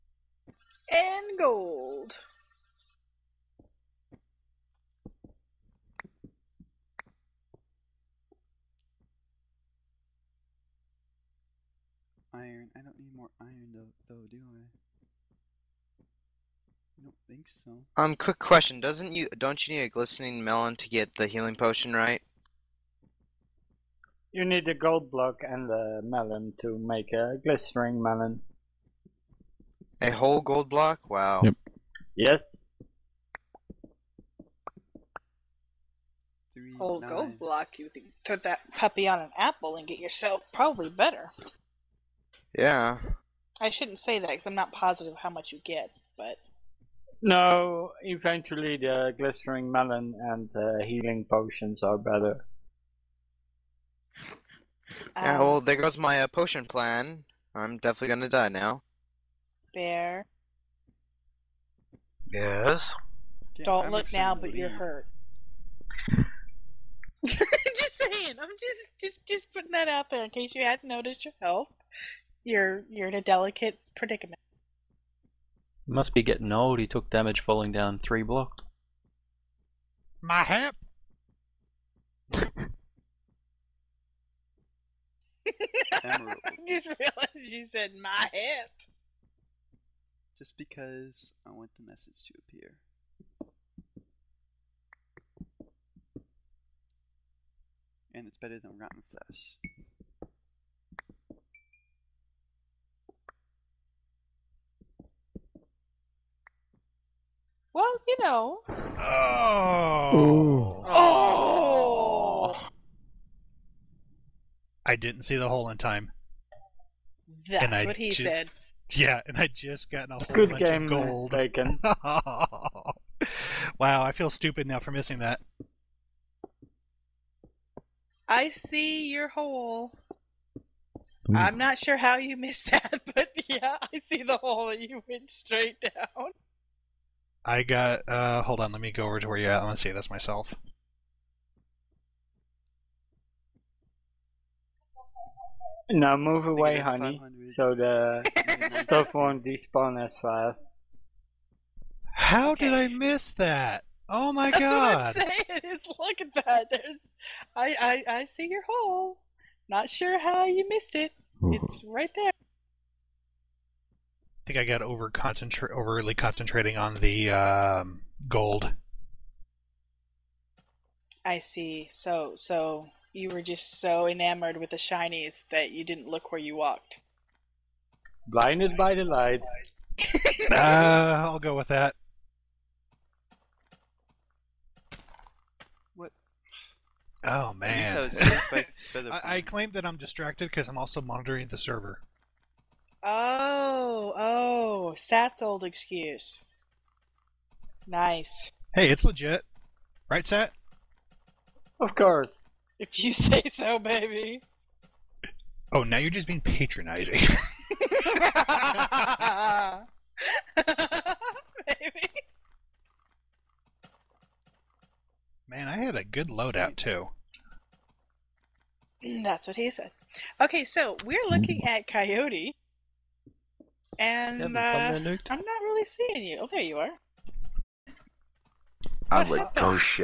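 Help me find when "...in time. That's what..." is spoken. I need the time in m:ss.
1:55.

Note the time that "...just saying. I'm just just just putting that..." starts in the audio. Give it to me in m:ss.
1:07.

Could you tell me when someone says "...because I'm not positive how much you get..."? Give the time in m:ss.
0:44.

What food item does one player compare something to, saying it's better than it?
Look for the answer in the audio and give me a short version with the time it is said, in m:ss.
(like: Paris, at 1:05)
Rotten Flesh, at 1:38.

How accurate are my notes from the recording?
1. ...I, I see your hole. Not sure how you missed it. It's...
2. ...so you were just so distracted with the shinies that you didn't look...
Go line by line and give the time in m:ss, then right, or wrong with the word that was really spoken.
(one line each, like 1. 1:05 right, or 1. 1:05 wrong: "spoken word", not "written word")
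1. 2:38 right
2. 2:52 wrong: "enamored", not "distracted".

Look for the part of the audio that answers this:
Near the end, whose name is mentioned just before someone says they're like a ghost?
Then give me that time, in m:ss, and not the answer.
3:41.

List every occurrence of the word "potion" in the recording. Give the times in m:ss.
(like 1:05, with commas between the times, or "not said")
0:21, 0:51, 0:56.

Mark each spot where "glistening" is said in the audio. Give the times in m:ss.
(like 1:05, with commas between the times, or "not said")
0:19, 0:27, 0:49.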